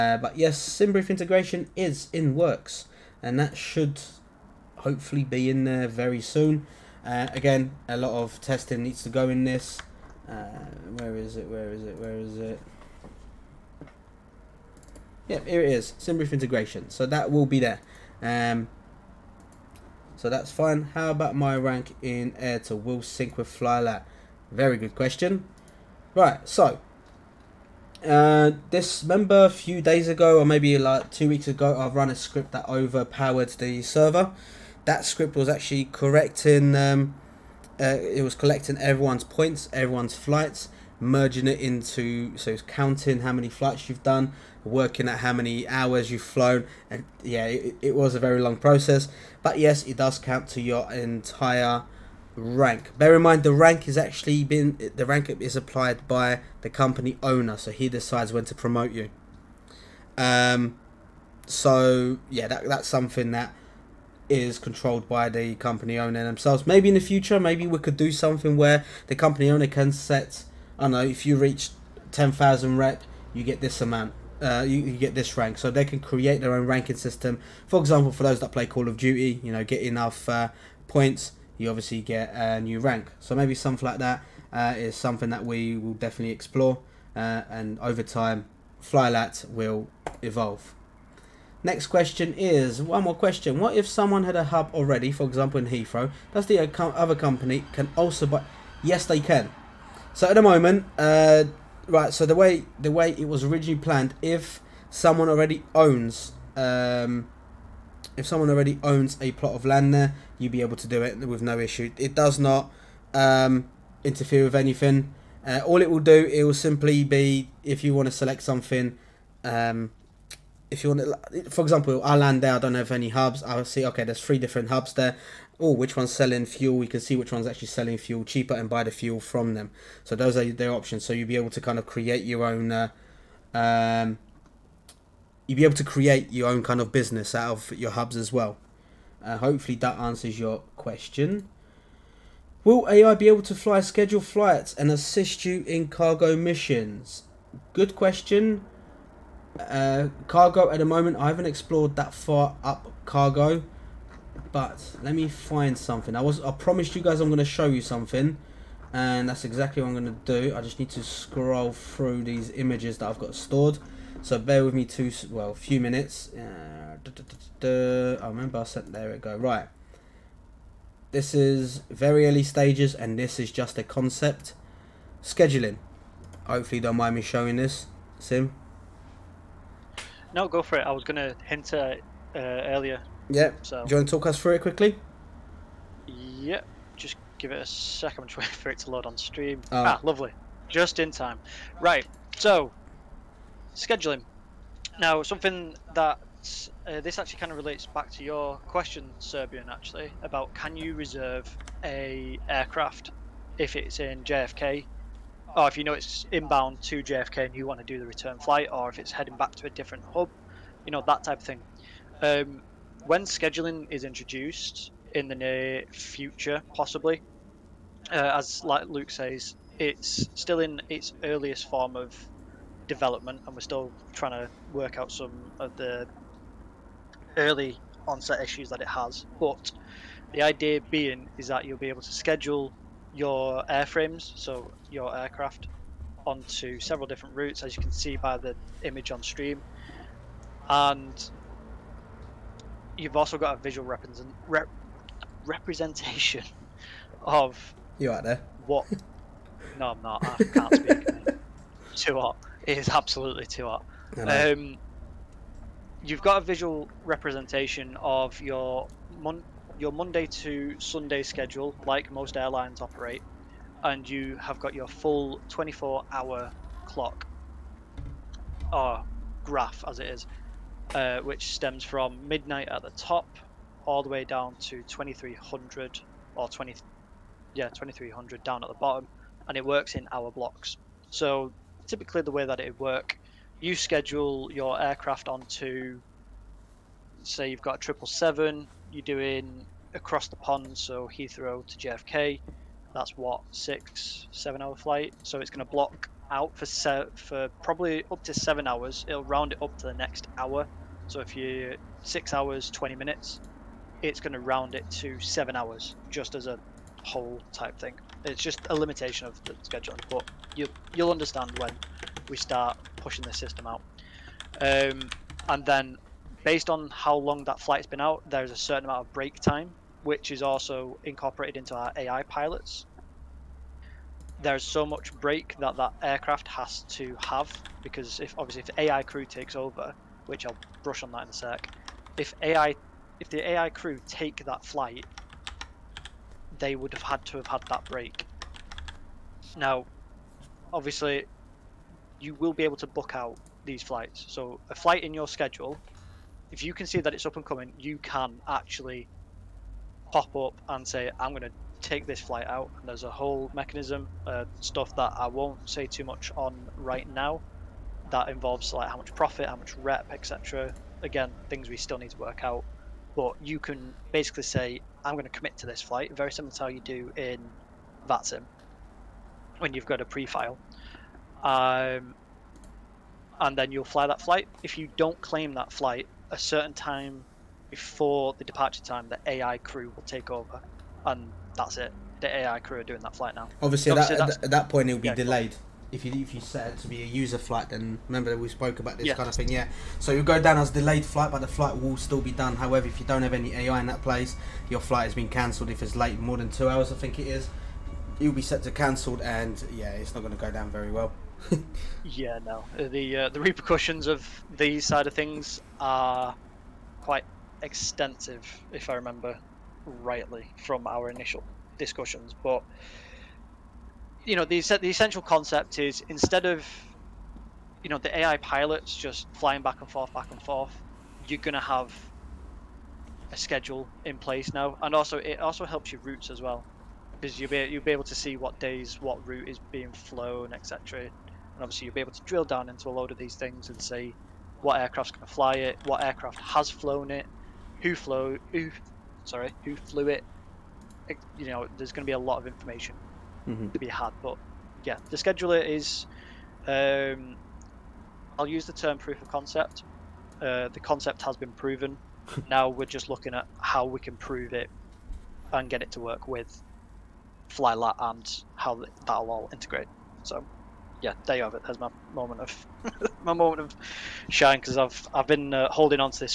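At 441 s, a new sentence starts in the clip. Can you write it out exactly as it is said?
You know, there's going to be a lot of information mm-hmm.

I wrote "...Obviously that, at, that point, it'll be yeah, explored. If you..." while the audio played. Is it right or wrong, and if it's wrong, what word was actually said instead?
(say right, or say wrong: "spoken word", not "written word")
wrong: "delayed", not "explored".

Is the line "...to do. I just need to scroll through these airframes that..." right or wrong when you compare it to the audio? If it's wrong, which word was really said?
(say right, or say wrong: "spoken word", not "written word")
wrong: "images", not "airframes".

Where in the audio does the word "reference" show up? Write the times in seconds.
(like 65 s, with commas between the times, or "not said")
not said.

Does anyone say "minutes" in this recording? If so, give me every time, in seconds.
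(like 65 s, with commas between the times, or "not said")
165 s, 302 s.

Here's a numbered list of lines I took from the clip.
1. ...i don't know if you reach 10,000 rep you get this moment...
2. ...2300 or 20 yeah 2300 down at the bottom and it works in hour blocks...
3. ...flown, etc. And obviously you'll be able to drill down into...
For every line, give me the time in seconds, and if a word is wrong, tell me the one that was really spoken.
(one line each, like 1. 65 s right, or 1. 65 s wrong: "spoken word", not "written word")
1. 70 s wrong: "amount", not "moment"
2. 274 s right
3. 429 s right.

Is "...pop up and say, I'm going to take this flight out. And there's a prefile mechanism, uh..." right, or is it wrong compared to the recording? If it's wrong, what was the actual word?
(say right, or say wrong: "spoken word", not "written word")
wrong: "whole", not "prefile".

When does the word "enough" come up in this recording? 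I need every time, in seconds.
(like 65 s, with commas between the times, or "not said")
79 s.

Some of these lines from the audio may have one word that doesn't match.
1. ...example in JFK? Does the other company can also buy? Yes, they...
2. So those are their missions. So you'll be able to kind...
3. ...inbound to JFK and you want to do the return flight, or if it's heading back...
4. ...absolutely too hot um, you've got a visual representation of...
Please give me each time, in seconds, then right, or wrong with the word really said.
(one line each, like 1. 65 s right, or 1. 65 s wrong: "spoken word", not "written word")
1. 95 s wrong: "Heathrow", not "JFK"
2. 130 s wrong: "options", not "missions"
3. 206 s right
4. 252 s right.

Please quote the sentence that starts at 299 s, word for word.
It'll round it up to the next hour.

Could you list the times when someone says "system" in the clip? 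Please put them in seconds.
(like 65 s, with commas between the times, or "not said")
76 s, 313 s.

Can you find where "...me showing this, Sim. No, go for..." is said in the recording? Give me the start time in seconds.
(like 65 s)
177 s.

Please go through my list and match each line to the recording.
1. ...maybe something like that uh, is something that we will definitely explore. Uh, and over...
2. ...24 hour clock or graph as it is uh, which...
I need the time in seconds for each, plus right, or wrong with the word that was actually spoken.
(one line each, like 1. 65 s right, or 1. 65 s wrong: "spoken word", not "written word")
1. 83 s right
2. 265 s right.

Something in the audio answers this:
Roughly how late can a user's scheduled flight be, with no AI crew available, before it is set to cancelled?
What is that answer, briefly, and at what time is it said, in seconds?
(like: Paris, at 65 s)
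2 hours, at 396 s.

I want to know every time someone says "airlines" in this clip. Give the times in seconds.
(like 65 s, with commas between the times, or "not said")
262 s.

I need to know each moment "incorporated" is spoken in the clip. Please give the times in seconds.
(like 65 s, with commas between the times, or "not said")
321 s.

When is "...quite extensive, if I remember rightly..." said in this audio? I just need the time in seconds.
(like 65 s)
407 s.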